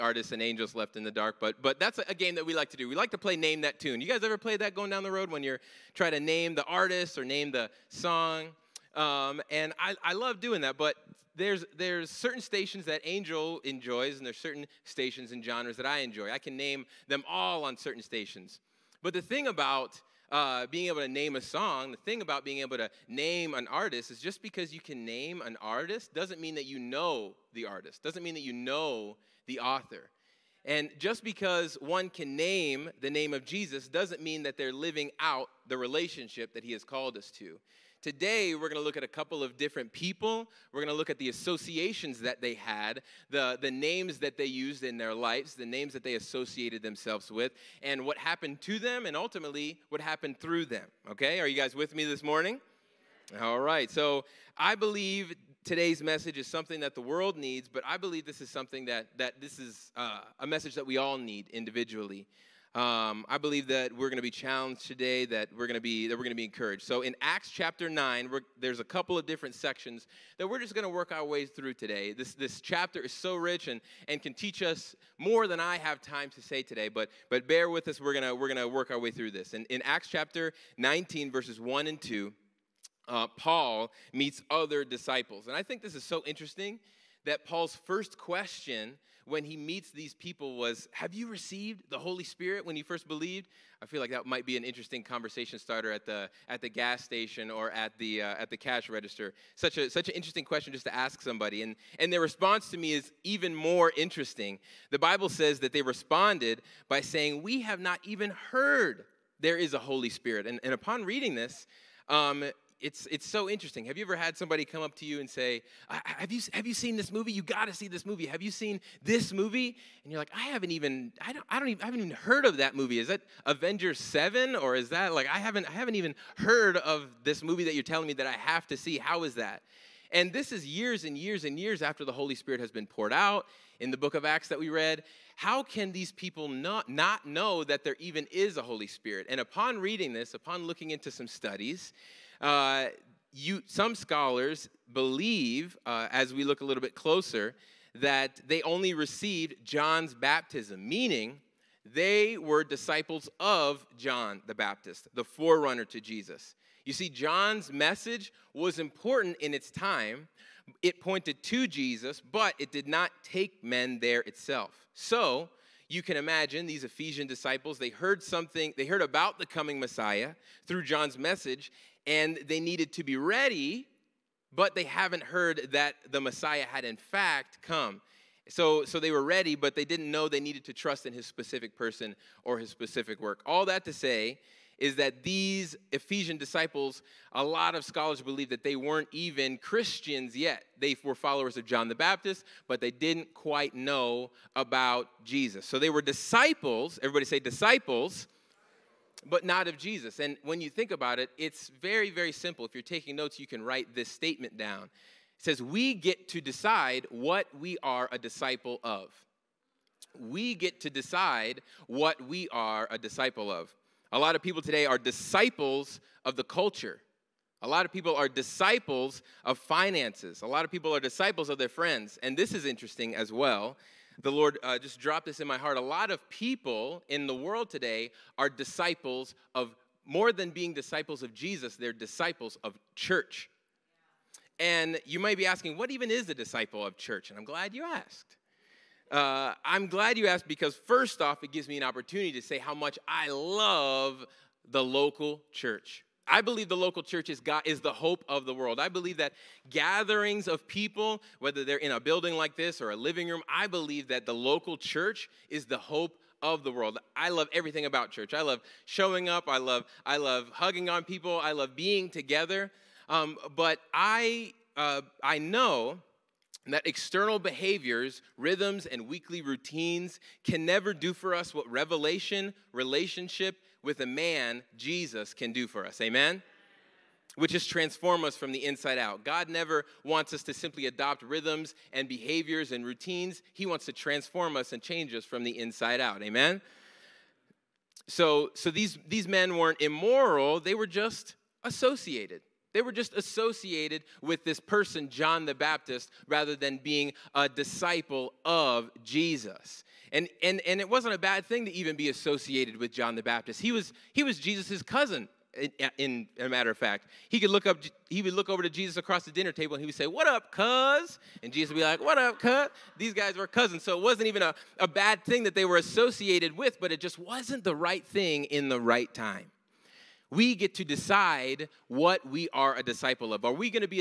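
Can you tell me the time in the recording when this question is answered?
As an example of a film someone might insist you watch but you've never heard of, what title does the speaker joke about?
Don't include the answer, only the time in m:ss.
2:03.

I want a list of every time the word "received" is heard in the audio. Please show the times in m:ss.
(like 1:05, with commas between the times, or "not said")
1:31, 2:28.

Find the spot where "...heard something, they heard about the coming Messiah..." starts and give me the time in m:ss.
2:47.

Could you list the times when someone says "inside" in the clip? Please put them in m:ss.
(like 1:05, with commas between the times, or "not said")
4:38, 4:45.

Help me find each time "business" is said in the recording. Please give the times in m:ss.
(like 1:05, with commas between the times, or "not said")
not said.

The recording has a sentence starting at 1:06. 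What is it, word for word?
So in Acts chapter 9 there's a couple of different sections that we're just going to work our way through today.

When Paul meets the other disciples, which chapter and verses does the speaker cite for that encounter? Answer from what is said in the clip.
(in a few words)
Acts 19:1-2.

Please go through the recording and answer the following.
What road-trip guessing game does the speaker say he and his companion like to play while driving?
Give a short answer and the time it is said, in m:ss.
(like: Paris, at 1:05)
Name That Tune, at 0:03.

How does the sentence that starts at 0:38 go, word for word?
Today, we're going to look at a couple of different people.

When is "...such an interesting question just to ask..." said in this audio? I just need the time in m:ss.
1:39.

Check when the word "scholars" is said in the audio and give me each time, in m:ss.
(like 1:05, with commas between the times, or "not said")
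2:23, 3:07.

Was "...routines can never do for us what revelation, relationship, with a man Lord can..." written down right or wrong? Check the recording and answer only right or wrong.
wrong.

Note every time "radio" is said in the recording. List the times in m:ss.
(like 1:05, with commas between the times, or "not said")
not said.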